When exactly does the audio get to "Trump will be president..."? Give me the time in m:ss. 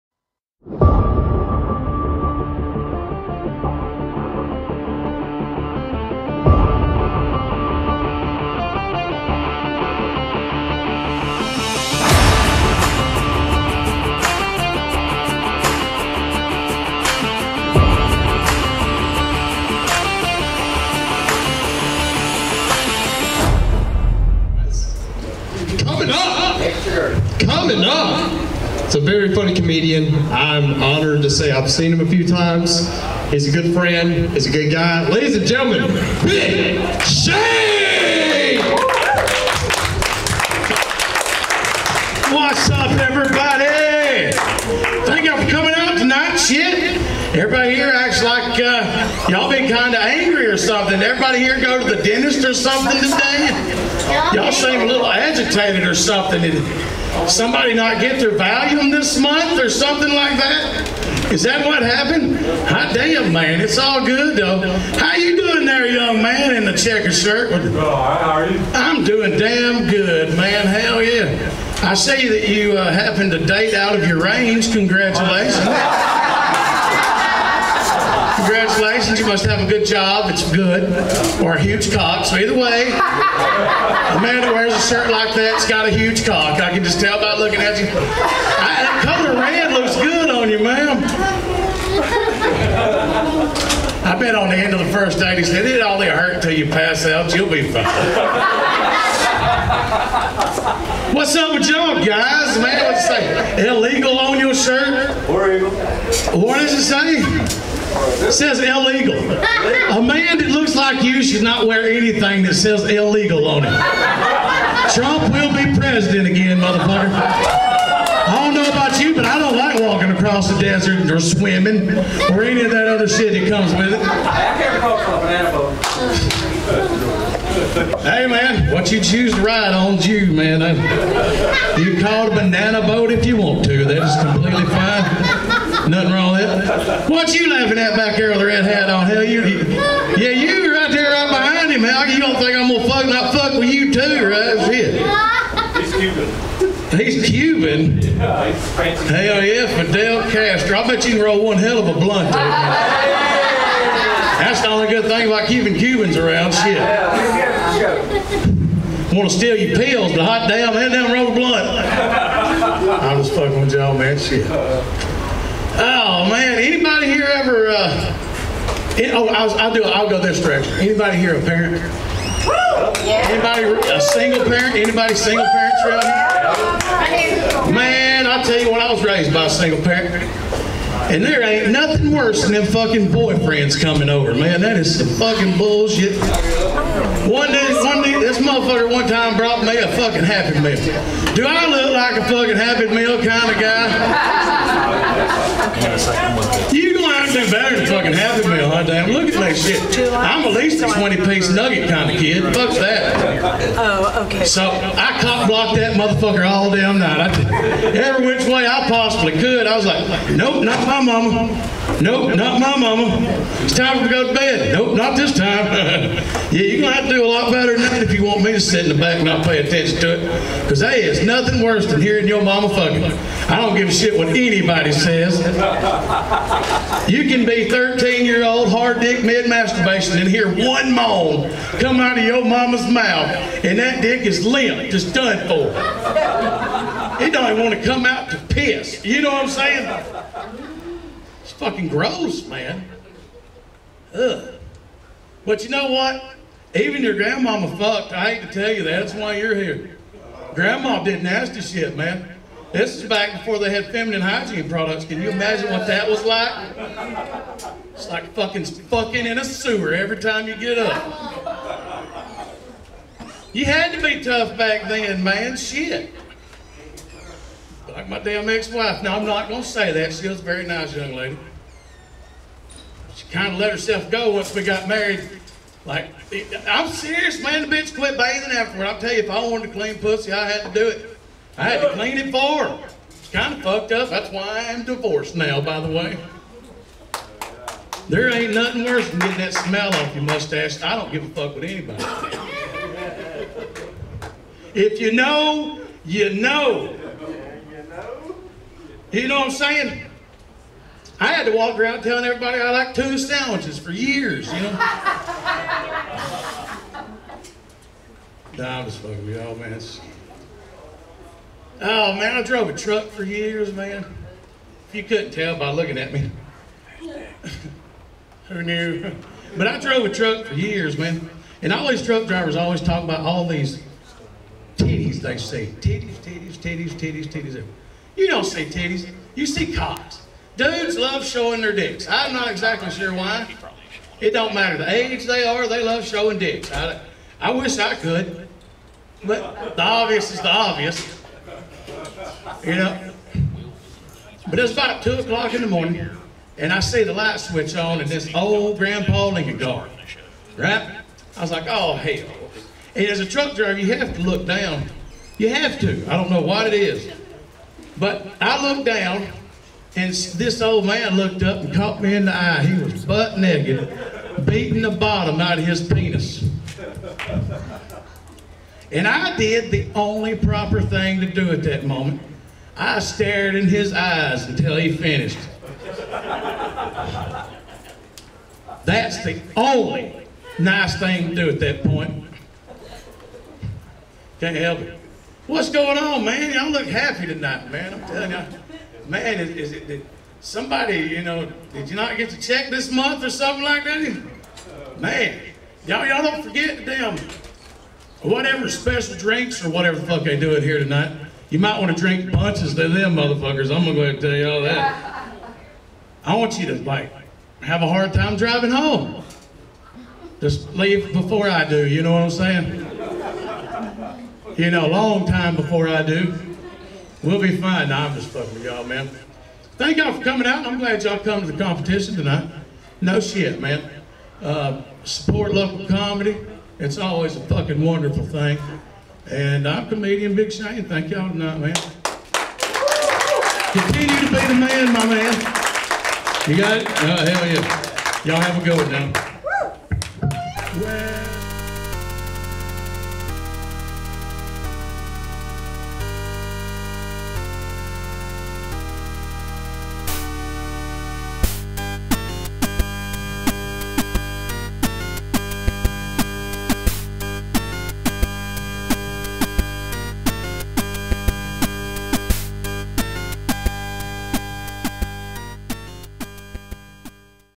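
1:54.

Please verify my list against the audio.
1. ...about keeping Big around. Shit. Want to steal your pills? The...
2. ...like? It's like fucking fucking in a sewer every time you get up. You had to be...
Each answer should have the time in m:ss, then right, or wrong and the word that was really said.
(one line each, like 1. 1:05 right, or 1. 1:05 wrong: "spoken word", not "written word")
1. 2:35 wrong: "Cubans", not "Big"
2. 4:16 right.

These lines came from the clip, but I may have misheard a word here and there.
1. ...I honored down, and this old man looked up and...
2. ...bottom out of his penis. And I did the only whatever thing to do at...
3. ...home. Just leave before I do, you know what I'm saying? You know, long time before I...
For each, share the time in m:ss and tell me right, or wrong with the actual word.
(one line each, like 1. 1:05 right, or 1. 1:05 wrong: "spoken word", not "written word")
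1. 5:58 wrong: "looked", not "honored"
2. 6:04 wrong: "proper", not "whatever"
3. 6:48 right.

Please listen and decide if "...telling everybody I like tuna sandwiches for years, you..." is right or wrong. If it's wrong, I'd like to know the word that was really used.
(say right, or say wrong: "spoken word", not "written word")
right.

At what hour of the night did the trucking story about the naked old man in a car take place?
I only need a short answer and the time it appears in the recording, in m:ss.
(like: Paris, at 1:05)
2 o'clock, at 5:45.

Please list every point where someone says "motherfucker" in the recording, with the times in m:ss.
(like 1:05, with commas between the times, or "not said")
1:56, 3:08, 3:25, 6:43.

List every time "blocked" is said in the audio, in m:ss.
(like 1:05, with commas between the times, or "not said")
3:25.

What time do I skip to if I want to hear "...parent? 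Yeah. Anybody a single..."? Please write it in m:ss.
2:51.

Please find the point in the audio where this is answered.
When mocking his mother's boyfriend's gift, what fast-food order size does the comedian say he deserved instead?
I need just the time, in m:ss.
3:20.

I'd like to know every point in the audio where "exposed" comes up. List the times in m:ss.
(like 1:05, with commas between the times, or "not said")
not said.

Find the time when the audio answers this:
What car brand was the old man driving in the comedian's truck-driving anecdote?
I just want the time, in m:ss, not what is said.
5:49.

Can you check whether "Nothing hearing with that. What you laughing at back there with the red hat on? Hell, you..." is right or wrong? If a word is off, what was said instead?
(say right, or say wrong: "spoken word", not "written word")
wrong: "wrong", not "hearing".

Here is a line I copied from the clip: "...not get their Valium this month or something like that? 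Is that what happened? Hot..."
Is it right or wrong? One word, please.
right.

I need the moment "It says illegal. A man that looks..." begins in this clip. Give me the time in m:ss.
1:47.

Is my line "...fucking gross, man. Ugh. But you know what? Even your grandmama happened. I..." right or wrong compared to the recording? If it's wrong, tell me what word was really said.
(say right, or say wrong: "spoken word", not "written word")
wrong: "fucked", not "happened".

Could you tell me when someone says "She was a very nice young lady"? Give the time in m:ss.
4:30.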